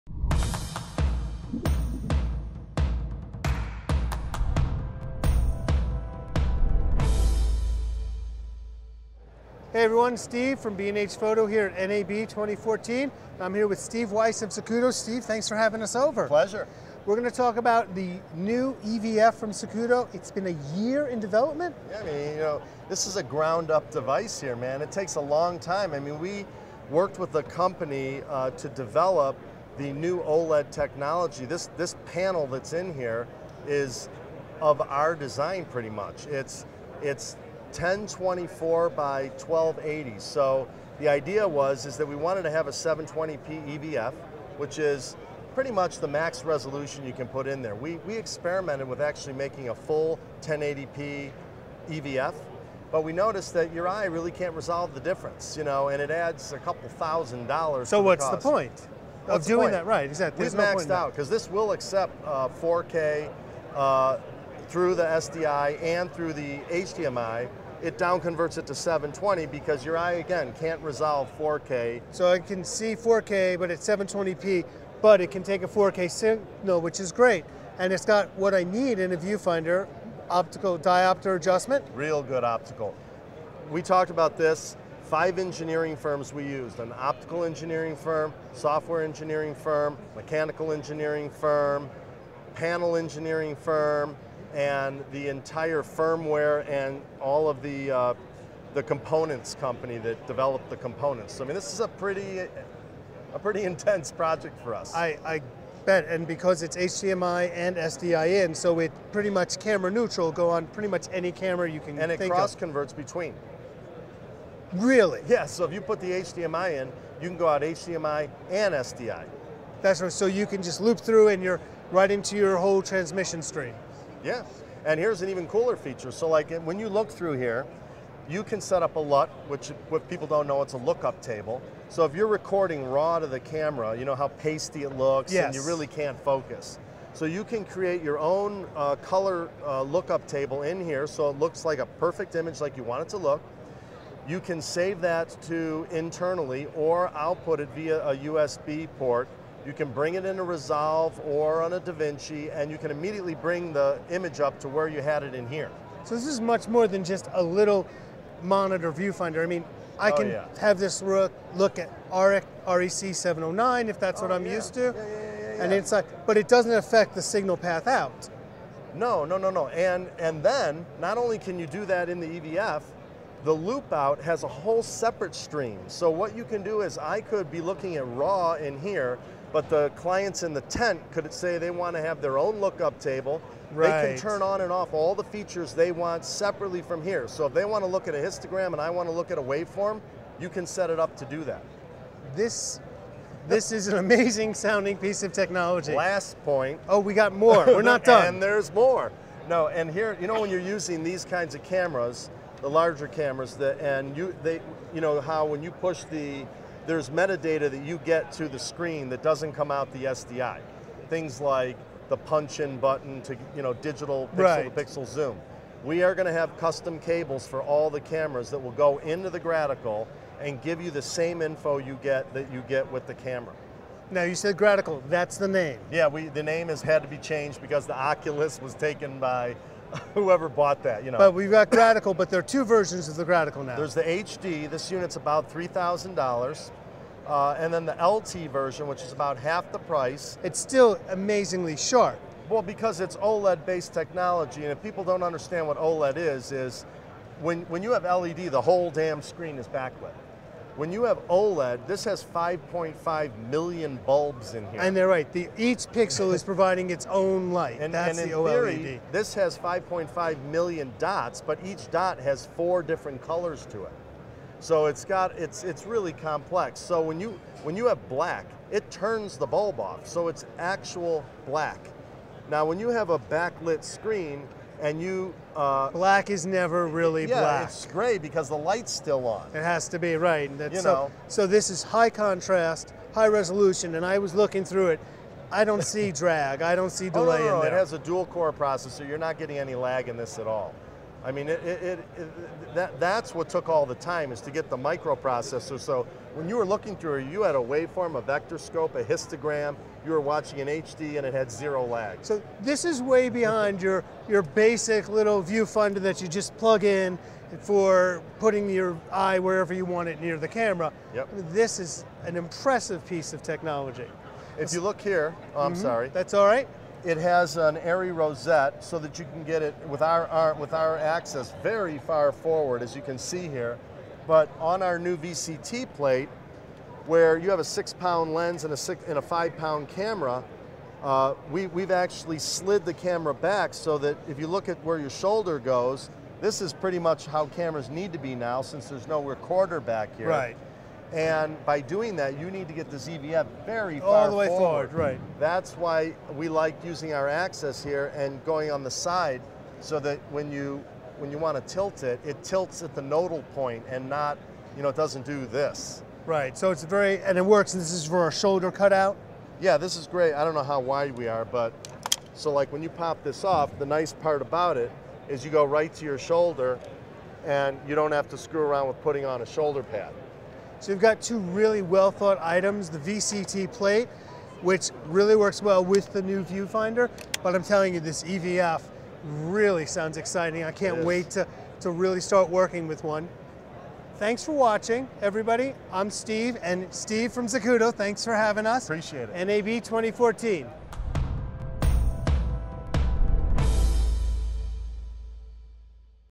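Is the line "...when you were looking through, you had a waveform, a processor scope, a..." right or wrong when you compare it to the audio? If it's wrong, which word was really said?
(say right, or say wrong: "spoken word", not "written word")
wrong: "vector", not "processor".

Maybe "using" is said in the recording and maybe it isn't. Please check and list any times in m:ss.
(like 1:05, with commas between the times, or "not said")
3:20, 5:46.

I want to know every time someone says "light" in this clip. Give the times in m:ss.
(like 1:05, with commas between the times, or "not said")
4:17, 4:38.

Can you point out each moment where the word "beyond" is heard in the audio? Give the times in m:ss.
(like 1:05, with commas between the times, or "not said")
5:03.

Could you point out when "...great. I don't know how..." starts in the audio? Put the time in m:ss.
6:00.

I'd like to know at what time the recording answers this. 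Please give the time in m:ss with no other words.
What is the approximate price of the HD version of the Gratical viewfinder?
3:55.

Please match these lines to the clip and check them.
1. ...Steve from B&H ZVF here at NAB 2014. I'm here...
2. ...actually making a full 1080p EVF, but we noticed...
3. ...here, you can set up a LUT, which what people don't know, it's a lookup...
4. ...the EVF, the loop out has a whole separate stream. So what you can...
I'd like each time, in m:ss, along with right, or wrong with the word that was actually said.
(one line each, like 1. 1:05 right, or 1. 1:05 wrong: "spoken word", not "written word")
1. 0:10 wrong: "Photo", not "ZVF"
2. 0:49 right
3. 2:07 right
4. 2:52 right.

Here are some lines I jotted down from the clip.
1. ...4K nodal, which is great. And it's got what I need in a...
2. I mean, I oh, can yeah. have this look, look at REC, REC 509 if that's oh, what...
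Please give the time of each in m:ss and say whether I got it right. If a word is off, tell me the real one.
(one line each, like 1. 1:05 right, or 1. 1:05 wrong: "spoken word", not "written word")
1. 1:15 wrong: "signal", not "nodal"
2. 2:39 wrong: "709", not "509".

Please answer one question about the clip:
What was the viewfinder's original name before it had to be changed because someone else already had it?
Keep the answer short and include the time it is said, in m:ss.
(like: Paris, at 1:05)
Oculus, at 3:47.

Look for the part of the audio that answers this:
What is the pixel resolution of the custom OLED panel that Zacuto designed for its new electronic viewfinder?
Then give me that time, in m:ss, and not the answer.
0:37.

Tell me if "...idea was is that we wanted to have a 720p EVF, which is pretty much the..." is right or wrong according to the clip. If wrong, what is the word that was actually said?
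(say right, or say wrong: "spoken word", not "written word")
right.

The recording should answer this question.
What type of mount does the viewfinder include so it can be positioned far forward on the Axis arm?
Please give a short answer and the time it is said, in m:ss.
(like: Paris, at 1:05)
Arri rosette, at 5:17.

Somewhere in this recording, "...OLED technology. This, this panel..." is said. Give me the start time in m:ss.
0:30.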